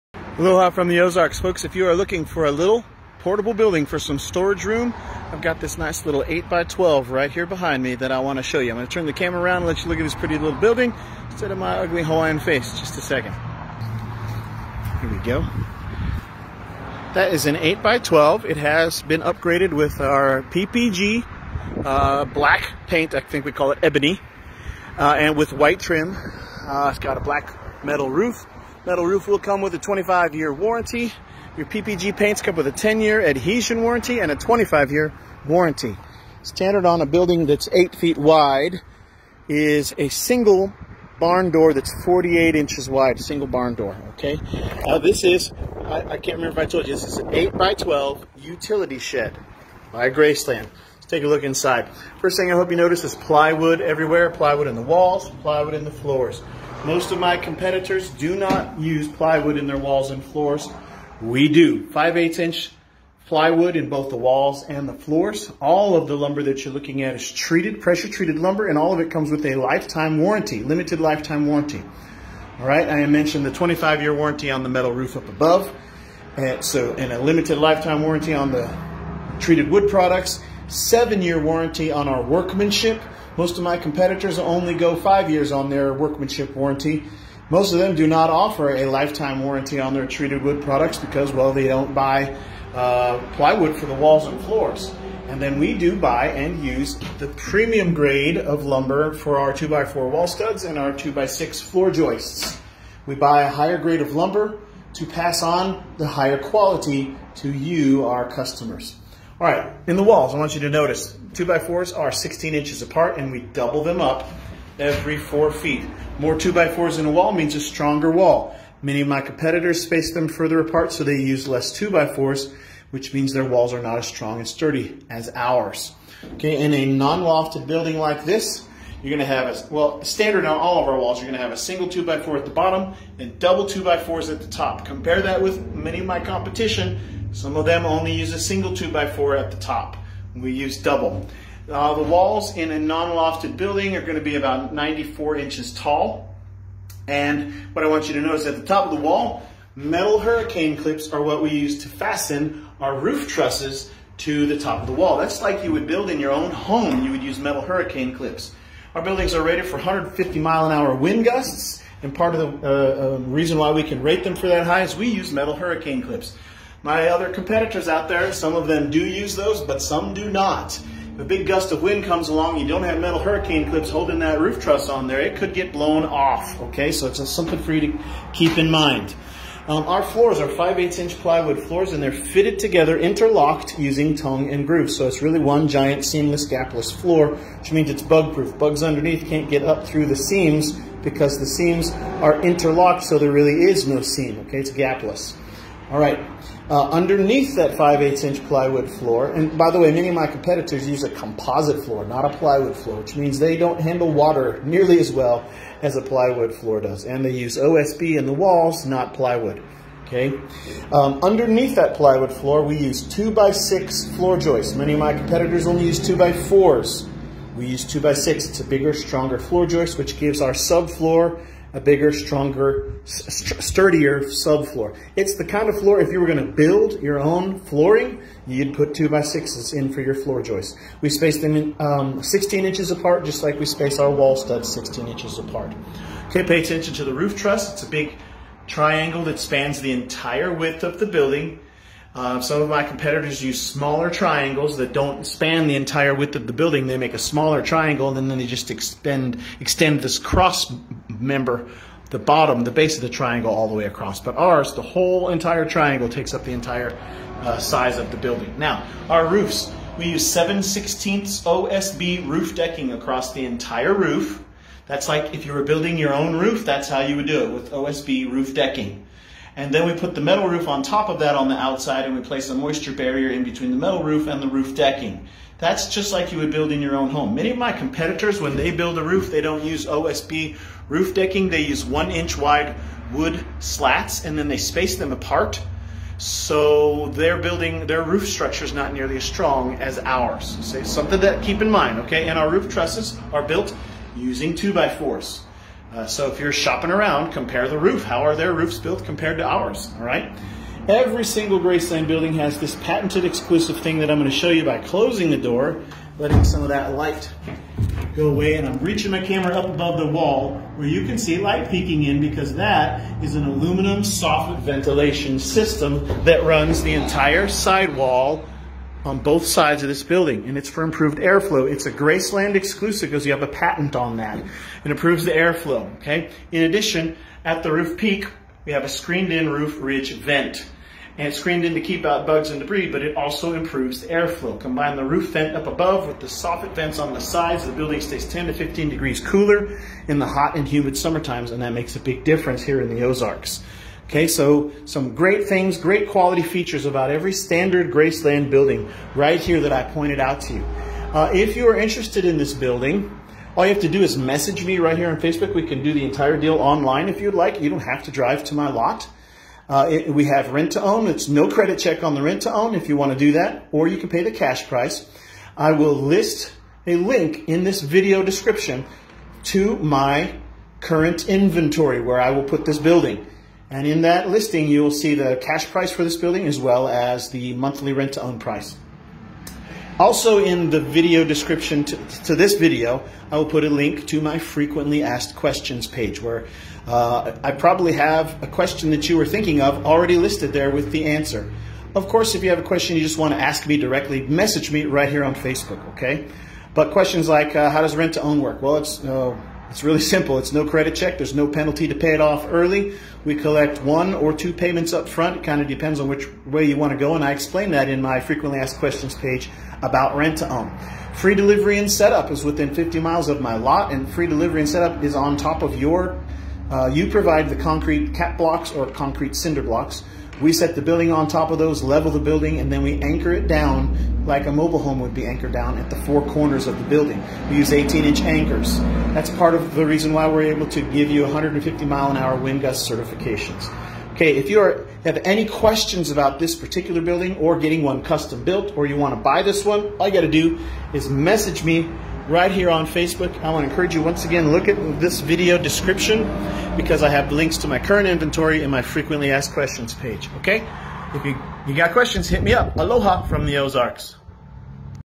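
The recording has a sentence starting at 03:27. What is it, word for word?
And they use OSB in the walls, not plywood.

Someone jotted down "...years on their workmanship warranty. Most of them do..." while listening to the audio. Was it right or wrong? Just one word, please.
right.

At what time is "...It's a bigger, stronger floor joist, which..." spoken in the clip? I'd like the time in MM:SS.
03:38.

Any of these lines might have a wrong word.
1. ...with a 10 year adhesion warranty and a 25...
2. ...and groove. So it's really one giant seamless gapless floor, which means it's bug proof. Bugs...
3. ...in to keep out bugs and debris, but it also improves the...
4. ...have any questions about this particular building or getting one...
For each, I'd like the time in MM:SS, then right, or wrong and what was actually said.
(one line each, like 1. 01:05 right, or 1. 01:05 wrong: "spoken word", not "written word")
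1. 00:32 right
2. 03:04 right
3. 05:31 right
4. 07:15 right.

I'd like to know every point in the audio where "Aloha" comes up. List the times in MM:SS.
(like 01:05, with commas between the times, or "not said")
00:00, 07:32.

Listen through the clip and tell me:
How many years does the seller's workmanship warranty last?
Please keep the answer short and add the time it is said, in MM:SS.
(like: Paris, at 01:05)
7 years, at 01:20.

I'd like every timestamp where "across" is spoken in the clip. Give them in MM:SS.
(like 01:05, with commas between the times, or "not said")
04:13, 04:22.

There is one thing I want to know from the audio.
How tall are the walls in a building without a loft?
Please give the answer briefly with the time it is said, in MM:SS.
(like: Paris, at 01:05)
94 inches, at 02:24.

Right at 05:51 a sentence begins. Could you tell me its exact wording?
Uh, if you are interested in this building, all you have to do is message me right here on Facebook.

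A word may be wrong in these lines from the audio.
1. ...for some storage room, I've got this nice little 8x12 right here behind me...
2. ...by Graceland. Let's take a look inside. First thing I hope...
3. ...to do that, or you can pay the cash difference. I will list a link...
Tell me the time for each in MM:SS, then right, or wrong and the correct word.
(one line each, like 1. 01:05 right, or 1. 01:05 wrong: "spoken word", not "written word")
1. 00:03 right
2. 00:49 right
3. 06:03 wrong: "price", not "difference".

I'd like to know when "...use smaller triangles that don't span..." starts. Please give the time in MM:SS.
04:03.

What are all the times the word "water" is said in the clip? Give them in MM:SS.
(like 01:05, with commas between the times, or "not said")
03:24.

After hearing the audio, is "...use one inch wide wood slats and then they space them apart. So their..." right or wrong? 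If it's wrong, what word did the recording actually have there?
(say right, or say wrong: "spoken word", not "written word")
right.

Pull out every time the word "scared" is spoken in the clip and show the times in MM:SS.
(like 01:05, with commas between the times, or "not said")
not said.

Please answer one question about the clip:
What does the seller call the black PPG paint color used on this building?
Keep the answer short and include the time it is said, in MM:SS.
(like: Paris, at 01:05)
ebony, at 00:23.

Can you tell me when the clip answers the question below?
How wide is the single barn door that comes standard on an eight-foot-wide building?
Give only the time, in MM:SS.
00:42.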